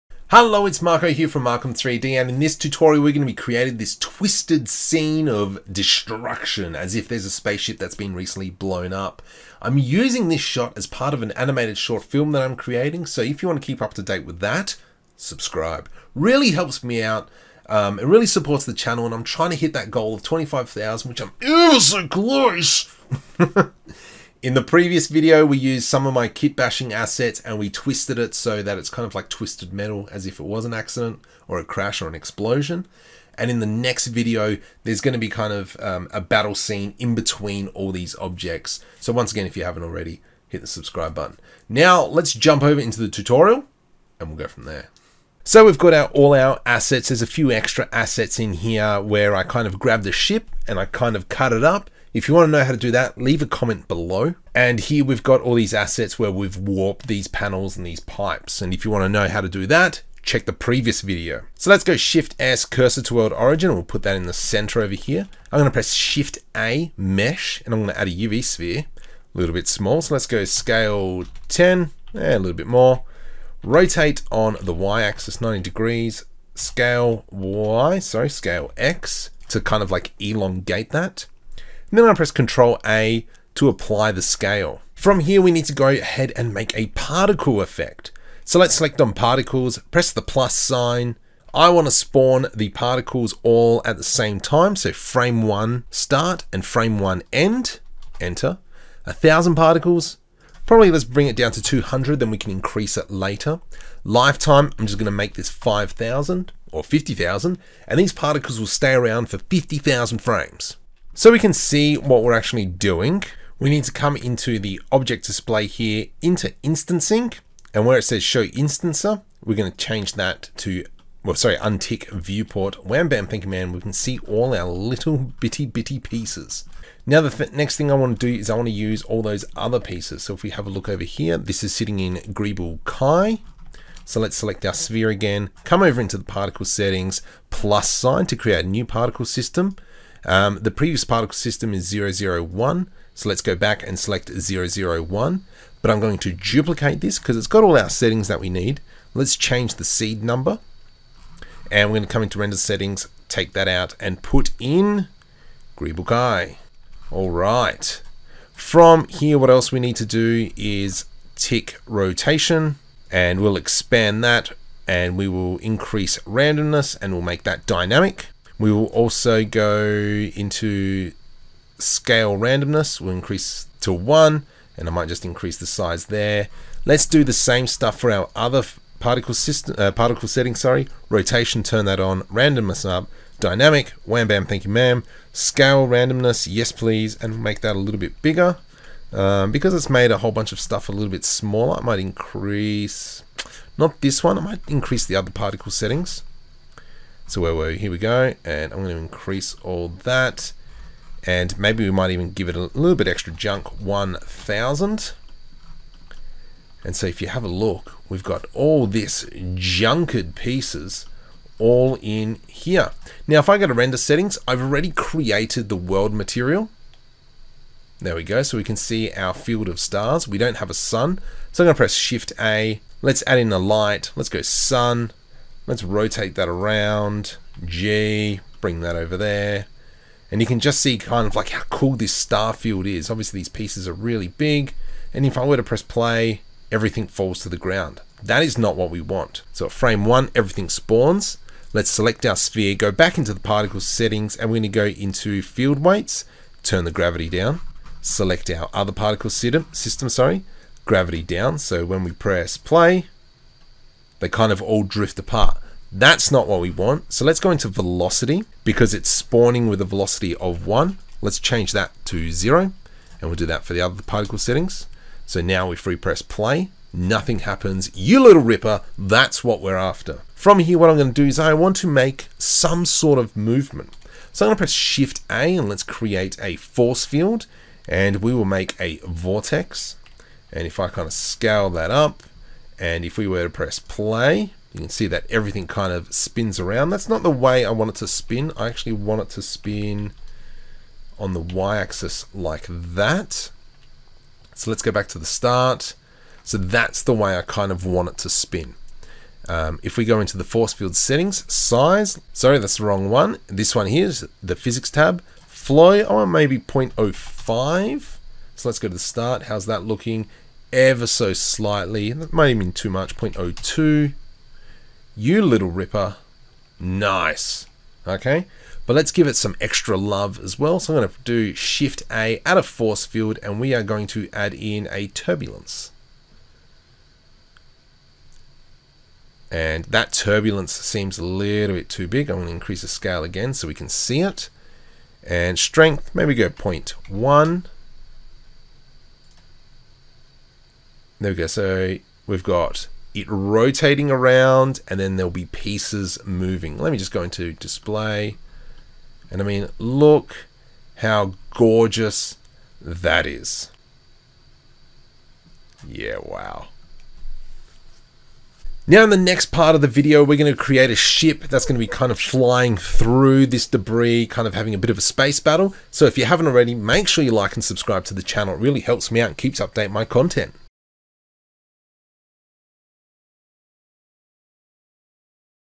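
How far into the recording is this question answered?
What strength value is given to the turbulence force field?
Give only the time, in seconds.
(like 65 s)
336 s.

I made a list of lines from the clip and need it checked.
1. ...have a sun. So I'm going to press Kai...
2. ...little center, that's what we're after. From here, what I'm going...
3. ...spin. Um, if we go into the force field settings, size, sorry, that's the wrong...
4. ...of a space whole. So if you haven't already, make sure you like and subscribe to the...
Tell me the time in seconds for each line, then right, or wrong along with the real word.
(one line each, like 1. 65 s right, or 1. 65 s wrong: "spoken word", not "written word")
1. 220 s wrong: "Shift", not "Kai"
2. 268 s wrong: "ripper", not "center"
3. 298 s right
4. 364 s wrong: "battle", not "whole".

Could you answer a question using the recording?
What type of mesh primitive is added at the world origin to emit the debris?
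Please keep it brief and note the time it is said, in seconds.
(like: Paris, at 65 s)
UV sphere, at 68 s.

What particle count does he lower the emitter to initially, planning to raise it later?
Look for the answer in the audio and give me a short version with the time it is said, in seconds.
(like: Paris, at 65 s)
200, at 101 s.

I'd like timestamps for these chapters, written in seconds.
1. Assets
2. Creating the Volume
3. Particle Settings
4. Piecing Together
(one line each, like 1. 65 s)
1. 45 s
2. 65 s
3. 118 s
4. 232 s.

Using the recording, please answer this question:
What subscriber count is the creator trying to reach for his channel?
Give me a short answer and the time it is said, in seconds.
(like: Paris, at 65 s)
25,000, at 20 s.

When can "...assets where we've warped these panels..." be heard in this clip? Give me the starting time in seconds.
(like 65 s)
55 s.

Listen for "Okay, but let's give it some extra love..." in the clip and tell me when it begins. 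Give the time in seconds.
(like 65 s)
318 s.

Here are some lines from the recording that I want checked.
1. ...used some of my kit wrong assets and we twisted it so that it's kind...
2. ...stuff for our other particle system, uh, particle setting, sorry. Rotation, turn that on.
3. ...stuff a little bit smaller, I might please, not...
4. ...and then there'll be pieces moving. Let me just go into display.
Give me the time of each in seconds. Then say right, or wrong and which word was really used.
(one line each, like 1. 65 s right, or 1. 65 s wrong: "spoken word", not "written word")
1. 25 s wrong: "bashing", not "wrong"
2. 177 s right
3. 190 s wrong: "increase", not "please"
4. 344 s right.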